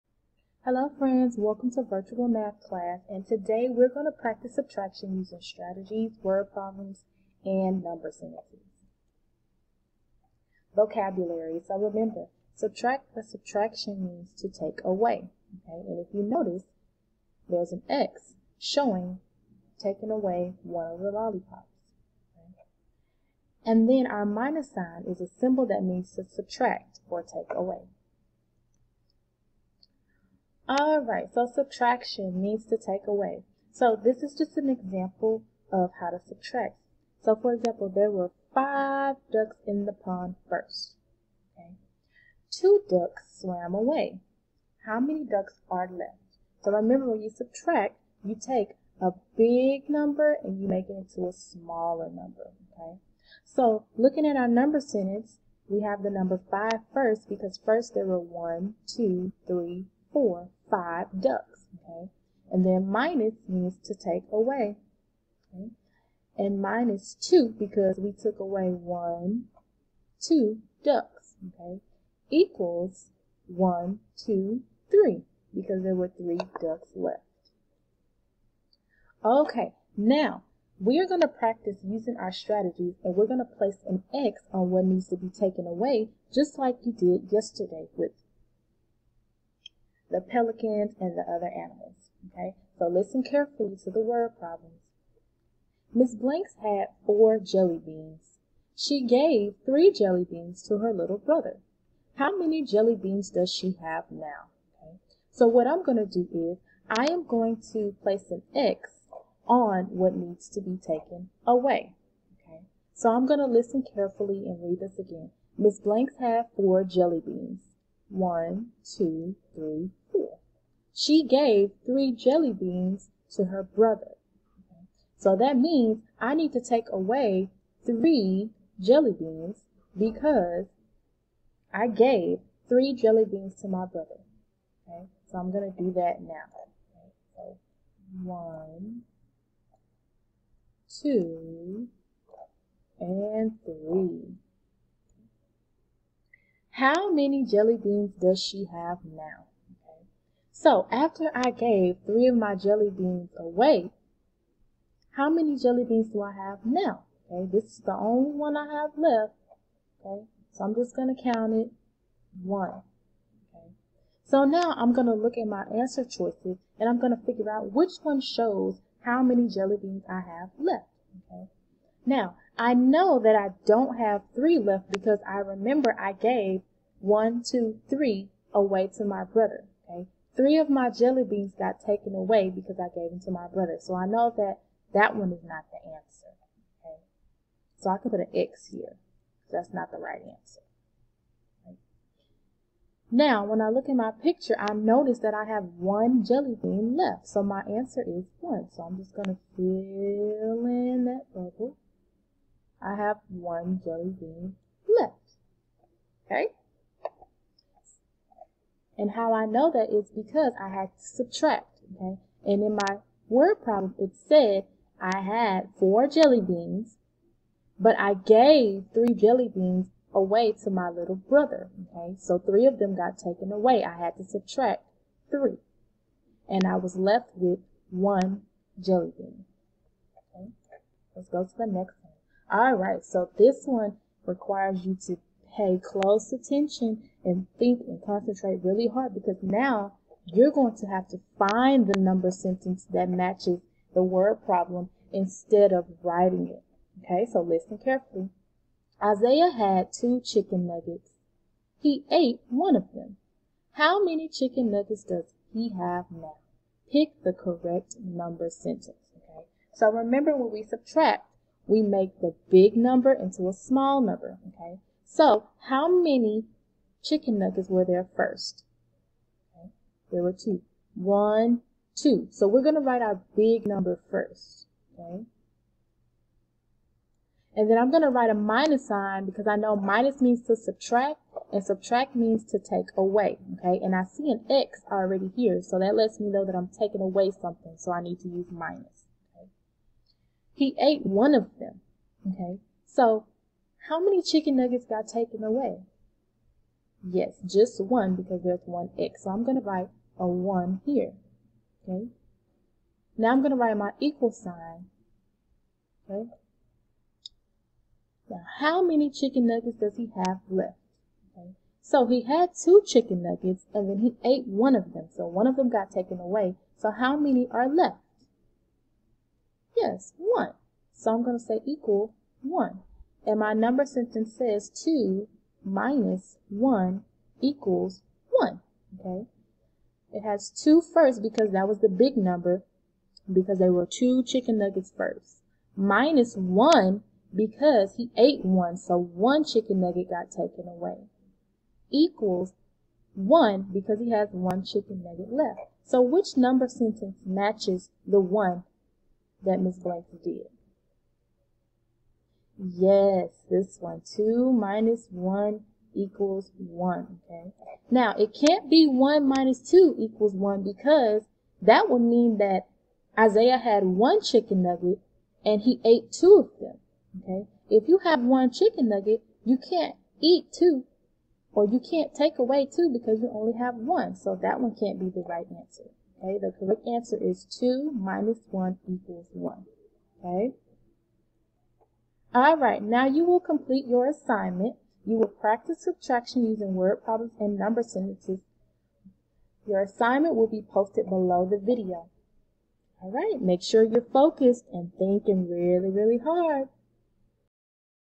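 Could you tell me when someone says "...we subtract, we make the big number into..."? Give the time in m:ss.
4:20.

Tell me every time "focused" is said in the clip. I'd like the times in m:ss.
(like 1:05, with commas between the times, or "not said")
6:34.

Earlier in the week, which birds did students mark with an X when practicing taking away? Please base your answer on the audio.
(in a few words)
pelicans.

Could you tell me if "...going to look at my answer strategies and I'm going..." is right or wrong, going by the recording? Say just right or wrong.
wrong.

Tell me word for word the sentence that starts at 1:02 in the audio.
And then minus means to take away, okay?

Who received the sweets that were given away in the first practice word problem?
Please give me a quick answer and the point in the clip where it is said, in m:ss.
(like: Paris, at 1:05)
her little brother, at 1:40.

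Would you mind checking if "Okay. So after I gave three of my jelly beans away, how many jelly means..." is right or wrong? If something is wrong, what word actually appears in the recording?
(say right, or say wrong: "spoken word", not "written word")
wrong: "beans", not "means".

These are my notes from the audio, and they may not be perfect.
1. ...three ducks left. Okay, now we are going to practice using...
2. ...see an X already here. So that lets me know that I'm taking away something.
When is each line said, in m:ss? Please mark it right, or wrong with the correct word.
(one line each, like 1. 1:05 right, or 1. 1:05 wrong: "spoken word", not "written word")
1. 1:16 right
2. 4:44 right.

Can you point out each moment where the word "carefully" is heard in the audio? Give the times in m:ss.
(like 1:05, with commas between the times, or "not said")
1:33, 1:53, 4:07.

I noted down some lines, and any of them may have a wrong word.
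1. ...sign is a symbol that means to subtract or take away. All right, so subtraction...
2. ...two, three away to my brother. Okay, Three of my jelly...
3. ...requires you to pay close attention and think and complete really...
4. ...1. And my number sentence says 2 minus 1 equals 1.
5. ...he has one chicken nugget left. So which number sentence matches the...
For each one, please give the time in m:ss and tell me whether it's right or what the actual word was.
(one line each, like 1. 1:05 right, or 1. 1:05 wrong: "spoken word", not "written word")
1. 0:24 right
2. 2:57 right
3. 3:54 wrong: "concentrate", not "complete"
4. 5:22 right
5. 5:43 right.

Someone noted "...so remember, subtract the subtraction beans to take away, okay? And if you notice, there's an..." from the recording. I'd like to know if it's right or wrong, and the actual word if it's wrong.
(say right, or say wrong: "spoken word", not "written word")
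wrong: "means", not "beans".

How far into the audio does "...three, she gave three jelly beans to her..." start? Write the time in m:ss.
1:59.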